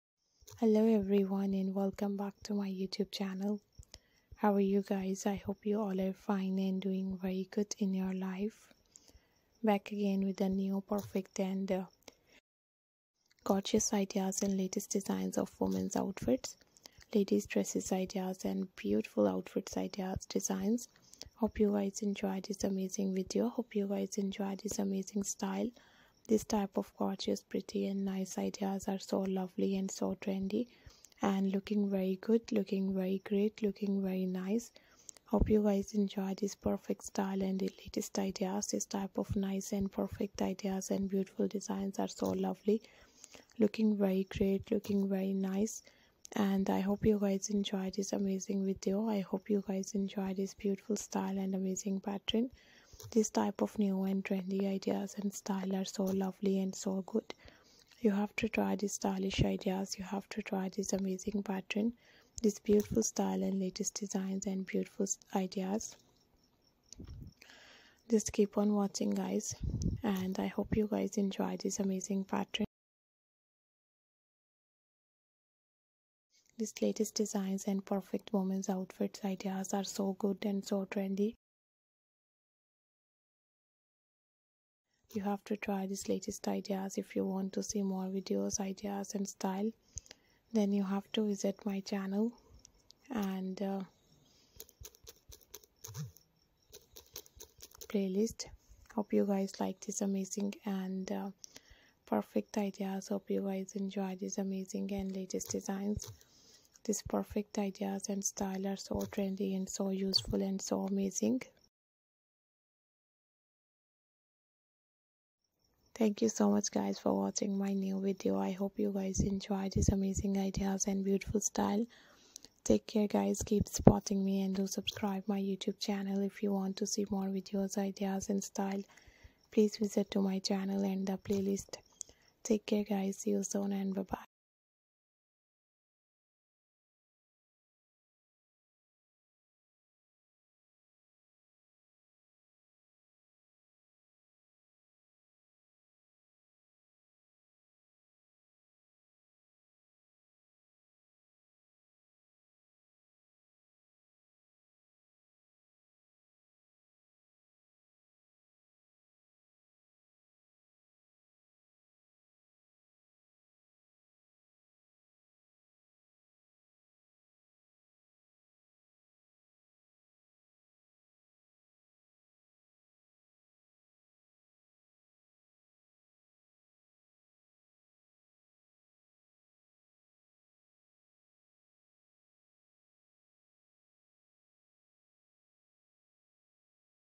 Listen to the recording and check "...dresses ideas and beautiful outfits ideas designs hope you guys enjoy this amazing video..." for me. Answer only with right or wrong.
right.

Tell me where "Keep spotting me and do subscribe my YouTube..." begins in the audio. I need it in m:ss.
2:03.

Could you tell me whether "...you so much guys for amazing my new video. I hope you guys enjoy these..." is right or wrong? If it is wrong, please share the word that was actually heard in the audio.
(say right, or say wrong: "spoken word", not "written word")
wrong: "watching", not "amazing".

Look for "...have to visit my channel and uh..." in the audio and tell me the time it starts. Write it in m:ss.
1:30.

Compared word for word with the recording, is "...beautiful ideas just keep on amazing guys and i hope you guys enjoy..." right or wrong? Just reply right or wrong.
wrong.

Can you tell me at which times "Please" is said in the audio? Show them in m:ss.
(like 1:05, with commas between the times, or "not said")
2:09.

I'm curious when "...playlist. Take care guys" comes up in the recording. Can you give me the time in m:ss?
2:11.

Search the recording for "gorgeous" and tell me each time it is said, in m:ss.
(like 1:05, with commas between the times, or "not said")
0:13, 0:26.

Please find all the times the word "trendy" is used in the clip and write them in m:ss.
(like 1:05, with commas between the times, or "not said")
0:30, 0:54, 1:20, 1:49.